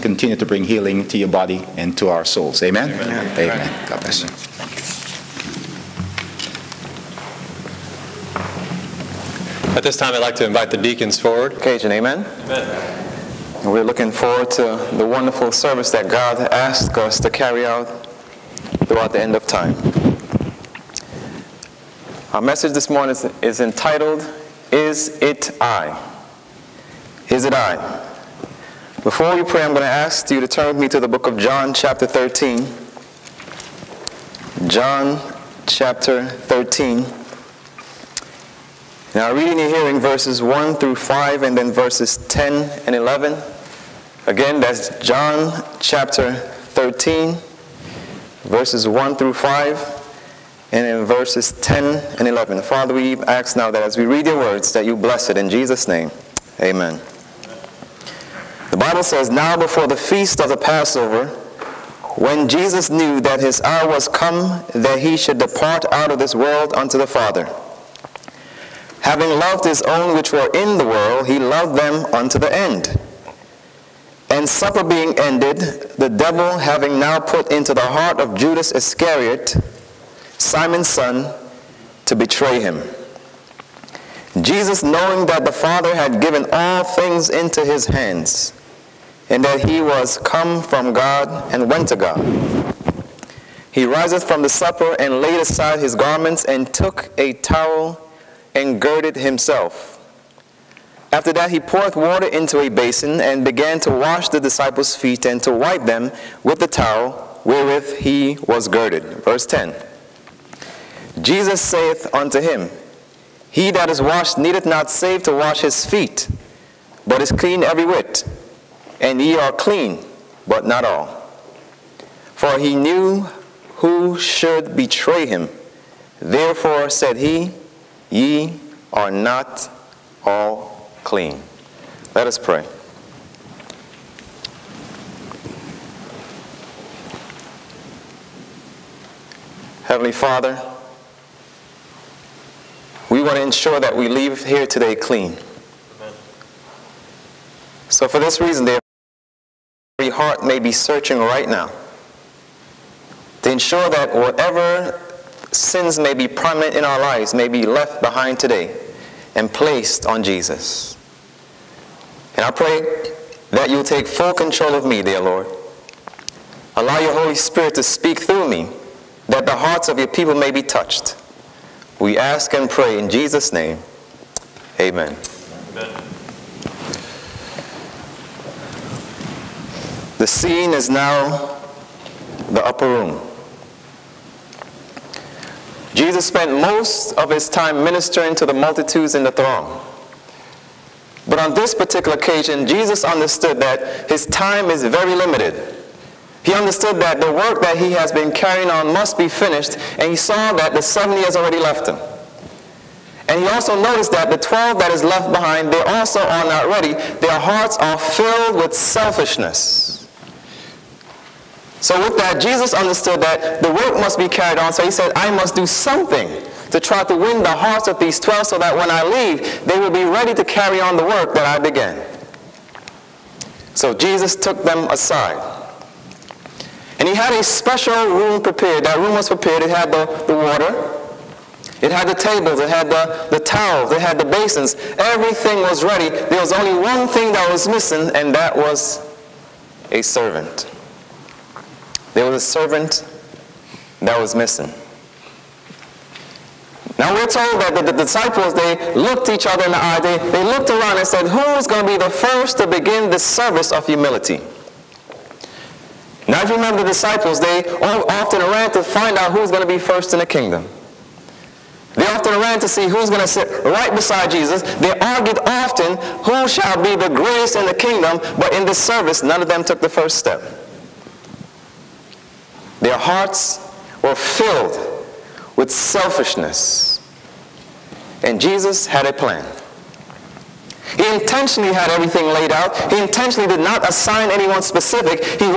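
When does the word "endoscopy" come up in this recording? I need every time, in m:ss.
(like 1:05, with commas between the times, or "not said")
not said.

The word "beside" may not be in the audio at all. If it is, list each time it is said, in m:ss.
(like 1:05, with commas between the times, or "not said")
4:23.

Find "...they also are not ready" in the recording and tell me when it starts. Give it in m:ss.
3:25.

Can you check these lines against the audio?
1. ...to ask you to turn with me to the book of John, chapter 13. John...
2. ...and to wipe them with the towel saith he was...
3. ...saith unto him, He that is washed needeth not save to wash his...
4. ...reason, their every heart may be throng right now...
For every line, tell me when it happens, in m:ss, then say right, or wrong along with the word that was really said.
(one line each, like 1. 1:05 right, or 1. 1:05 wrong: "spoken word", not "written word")
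1. 0:29 right
2. 1:45 wrong: "wherewith", not "saith"
3. 1:51 right
4. 2:28 wrong: "searching", not "throng".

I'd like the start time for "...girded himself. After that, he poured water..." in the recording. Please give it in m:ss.
1:38.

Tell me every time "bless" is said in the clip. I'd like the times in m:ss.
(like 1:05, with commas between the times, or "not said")
0:04, 0:54.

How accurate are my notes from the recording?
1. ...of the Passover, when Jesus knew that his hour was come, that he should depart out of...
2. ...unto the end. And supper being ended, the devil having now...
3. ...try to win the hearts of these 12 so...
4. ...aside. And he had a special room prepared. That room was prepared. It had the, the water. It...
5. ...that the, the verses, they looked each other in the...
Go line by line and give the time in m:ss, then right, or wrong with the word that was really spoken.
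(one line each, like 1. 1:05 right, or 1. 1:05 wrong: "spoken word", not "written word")
1. 1:00 right
2. 1:12 right
3. 3:36 right
4. 3:44 right
5. 4:07 wrong: "disciples", not "verses".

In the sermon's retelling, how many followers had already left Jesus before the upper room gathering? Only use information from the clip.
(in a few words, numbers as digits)
70.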